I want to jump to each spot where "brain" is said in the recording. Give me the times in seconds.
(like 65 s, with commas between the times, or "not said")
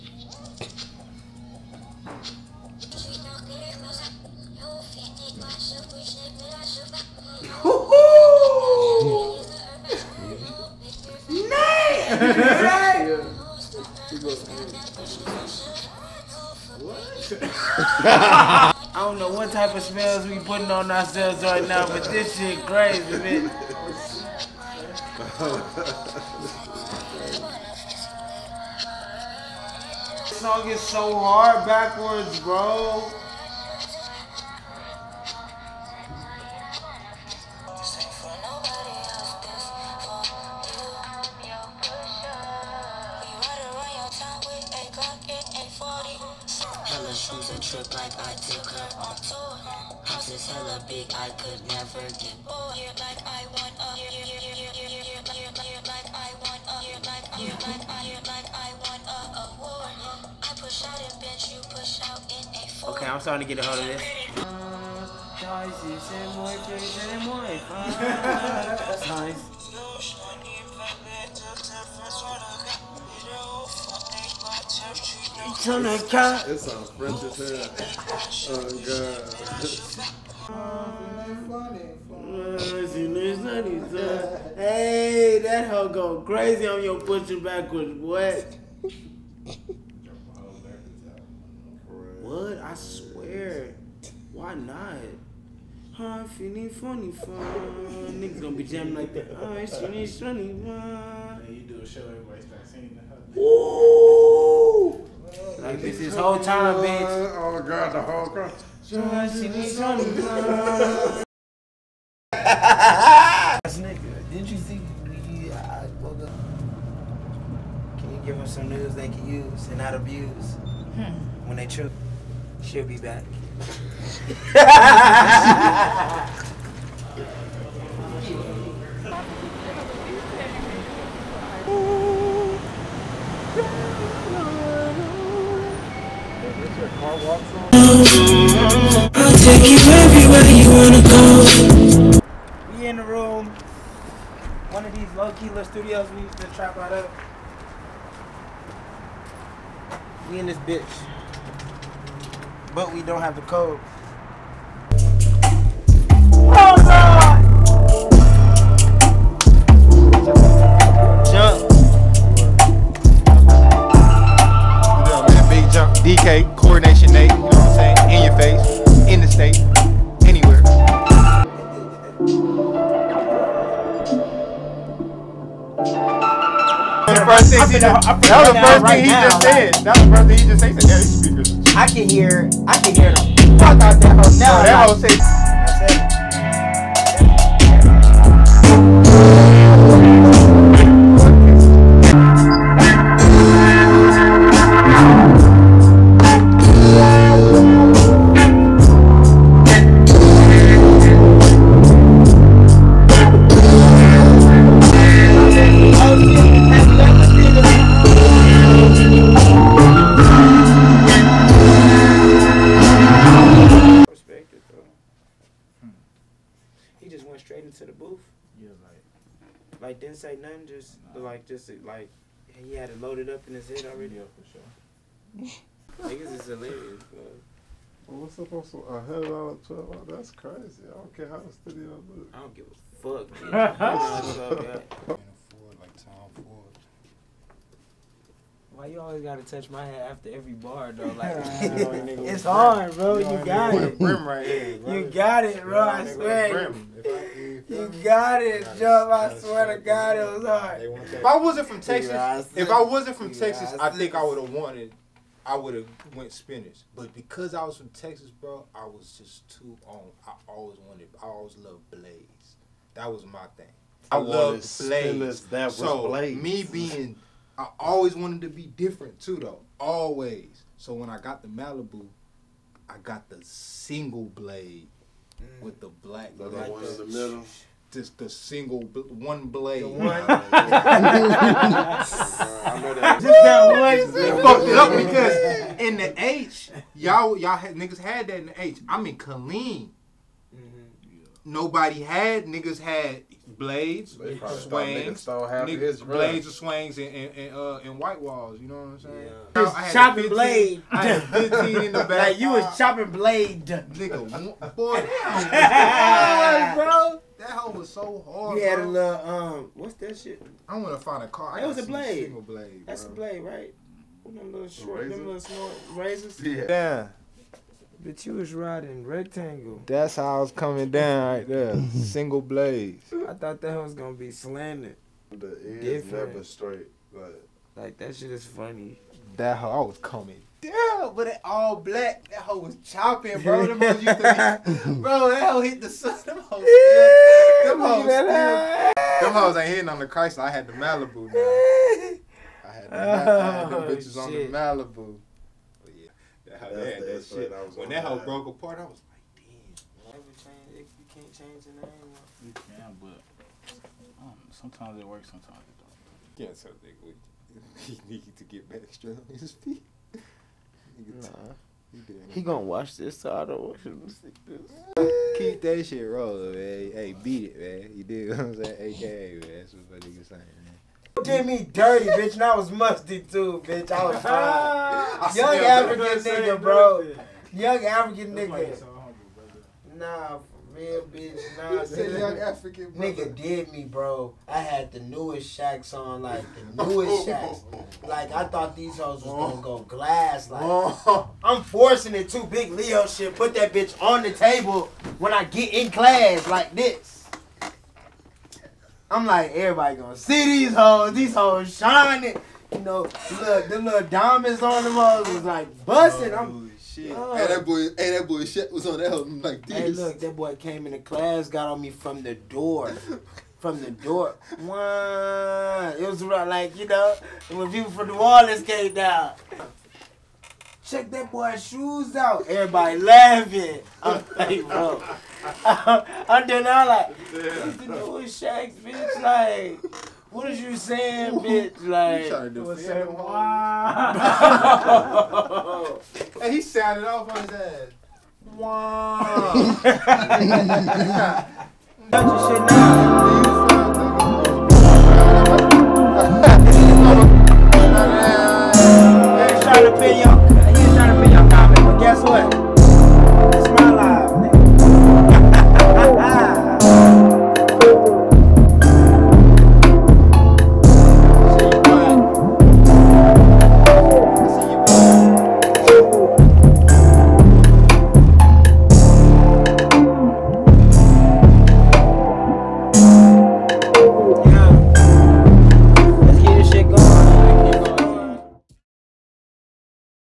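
not said.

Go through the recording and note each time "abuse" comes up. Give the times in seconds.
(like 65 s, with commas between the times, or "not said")
119 s.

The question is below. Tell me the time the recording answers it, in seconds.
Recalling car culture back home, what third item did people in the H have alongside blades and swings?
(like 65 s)
297 s.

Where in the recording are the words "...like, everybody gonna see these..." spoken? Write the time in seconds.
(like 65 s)
399 s.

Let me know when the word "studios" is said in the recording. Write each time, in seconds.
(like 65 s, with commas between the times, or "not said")
145 s, 231 s.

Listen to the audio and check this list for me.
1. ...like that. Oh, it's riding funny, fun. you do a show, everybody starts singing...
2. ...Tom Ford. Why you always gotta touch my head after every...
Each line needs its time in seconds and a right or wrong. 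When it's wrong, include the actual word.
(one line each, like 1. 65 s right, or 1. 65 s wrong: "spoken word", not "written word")
1. 98 s wrong: "feeling", not "riding"
2. 235 s right.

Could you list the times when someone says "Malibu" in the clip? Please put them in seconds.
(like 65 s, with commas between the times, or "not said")
271 s, 340 s, 344 s.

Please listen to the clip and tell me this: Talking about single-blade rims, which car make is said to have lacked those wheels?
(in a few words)
Chrysler.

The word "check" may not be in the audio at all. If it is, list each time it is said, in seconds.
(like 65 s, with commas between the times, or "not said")
420 s.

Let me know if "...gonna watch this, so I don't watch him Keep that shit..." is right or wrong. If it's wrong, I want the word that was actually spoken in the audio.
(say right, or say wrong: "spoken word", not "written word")
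right.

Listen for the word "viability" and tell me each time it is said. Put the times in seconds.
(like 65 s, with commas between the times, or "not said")
not said.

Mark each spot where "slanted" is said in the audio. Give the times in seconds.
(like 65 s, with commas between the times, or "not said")
324 s.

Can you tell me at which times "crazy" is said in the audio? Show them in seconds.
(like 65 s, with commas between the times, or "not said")
22 s, 86 s, 230 s.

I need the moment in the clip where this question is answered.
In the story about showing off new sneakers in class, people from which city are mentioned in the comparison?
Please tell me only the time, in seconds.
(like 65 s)
418 s.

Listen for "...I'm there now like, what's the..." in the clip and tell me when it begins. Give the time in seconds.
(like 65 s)
425 s.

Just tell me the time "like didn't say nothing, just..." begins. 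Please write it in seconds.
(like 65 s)
219 s.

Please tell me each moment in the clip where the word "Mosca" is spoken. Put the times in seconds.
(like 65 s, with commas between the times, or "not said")
not said.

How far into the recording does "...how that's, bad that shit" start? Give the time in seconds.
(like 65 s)
346 s.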